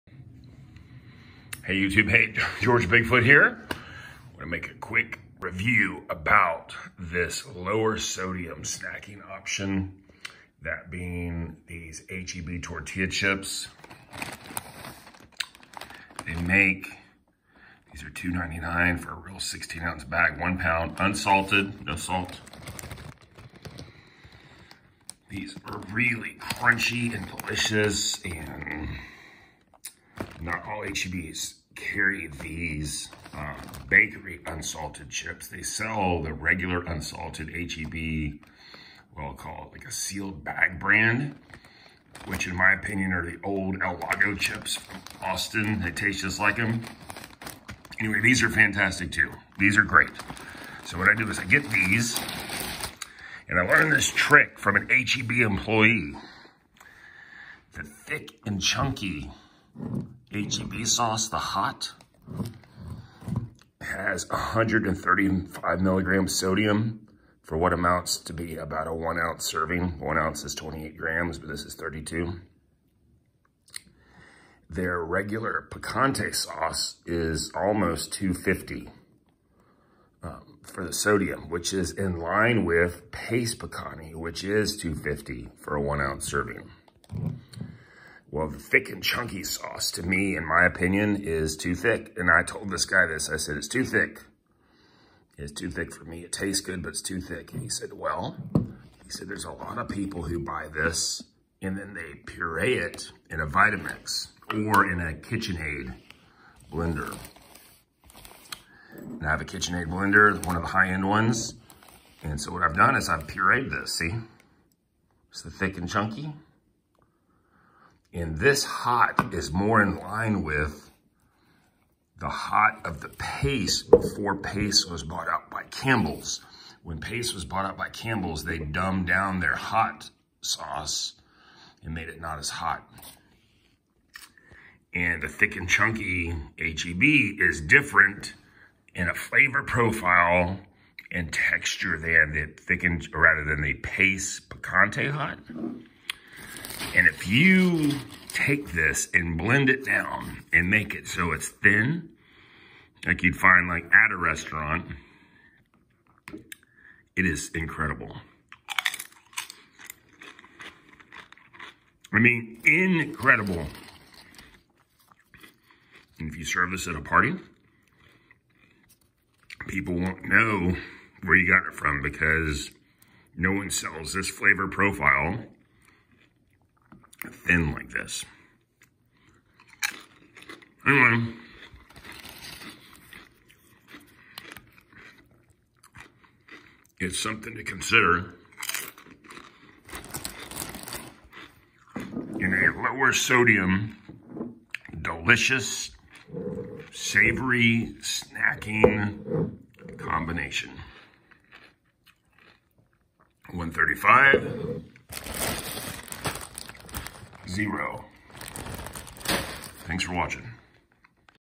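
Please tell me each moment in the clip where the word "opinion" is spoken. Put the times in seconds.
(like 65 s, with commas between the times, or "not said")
42 s, 90 s.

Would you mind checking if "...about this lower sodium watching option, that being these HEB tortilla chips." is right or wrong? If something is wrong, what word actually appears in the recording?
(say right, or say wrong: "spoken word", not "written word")
wrong: "snacking", not "watching".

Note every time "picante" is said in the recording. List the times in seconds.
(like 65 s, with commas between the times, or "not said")
75 s, 83 s, 144 s.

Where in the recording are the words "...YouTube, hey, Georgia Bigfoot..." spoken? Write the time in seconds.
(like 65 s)
1 s.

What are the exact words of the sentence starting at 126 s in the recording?
When Pace was bought out by Campbell's, they dumbed down their hot sauce and made it not as hot.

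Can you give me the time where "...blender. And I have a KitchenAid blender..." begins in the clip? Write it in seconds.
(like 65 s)
106 s.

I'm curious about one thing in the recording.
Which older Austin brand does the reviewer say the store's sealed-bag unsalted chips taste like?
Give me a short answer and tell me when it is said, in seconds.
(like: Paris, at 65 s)
El Lago, at 43 s.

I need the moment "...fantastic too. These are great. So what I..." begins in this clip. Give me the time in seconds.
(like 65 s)
48 s.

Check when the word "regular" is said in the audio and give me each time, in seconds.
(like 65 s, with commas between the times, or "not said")
36 s, 75 s.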